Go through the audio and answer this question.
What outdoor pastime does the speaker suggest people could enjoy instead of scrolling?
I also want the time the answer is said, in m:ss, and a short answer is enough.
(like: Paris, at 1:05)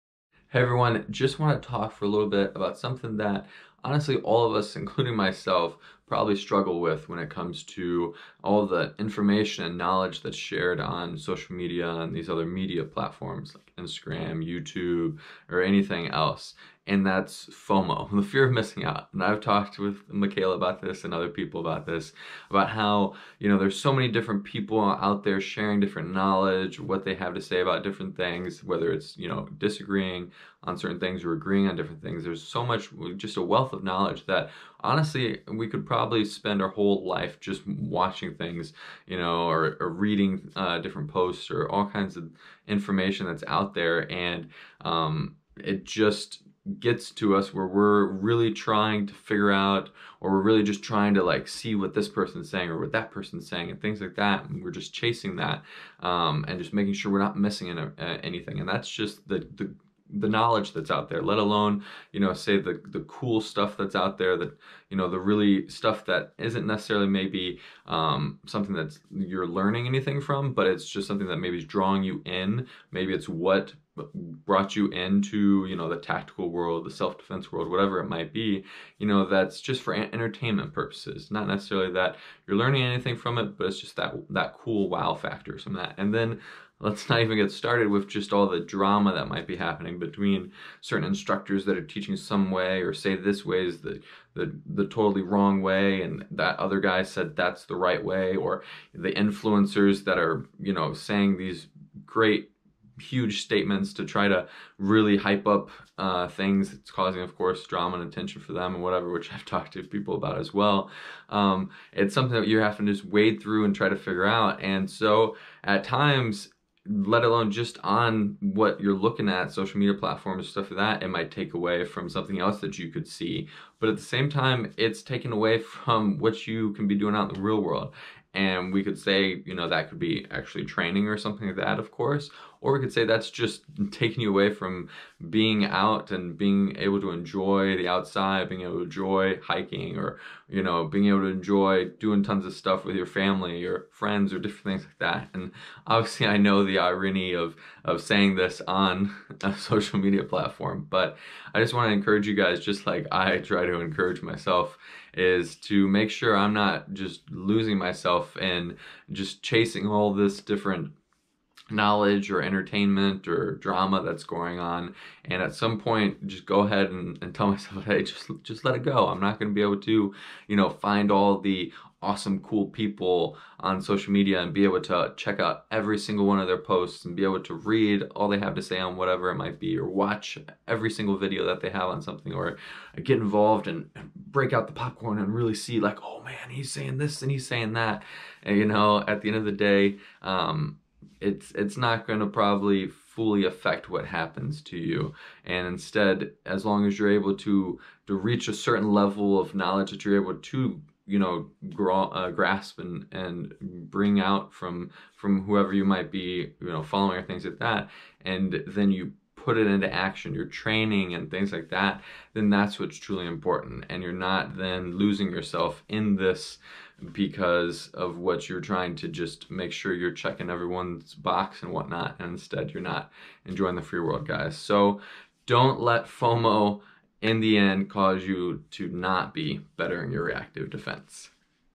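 hiking, at 2:19.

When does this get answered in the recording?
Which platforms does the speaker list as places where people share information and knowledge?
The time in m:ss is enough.
0:13.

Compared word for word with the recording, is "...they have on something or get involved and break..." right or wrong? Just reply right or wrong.
right.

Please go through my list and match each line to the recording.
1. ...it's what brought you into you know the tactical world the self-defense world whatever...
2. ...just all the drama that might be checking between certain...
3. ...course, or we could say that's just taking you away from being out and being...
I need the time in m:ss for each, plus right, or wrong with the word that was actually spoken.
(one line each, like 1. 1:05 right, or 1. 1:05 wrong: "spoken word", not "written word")
1. 1:13 right
2. 1:28 wrong: "happening", not "checking"
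3. 2:11 right.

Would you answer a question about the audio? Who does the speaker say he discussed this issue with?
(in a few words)
Michaela.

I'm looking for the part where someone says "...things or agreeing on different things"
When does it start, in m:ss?
0:30.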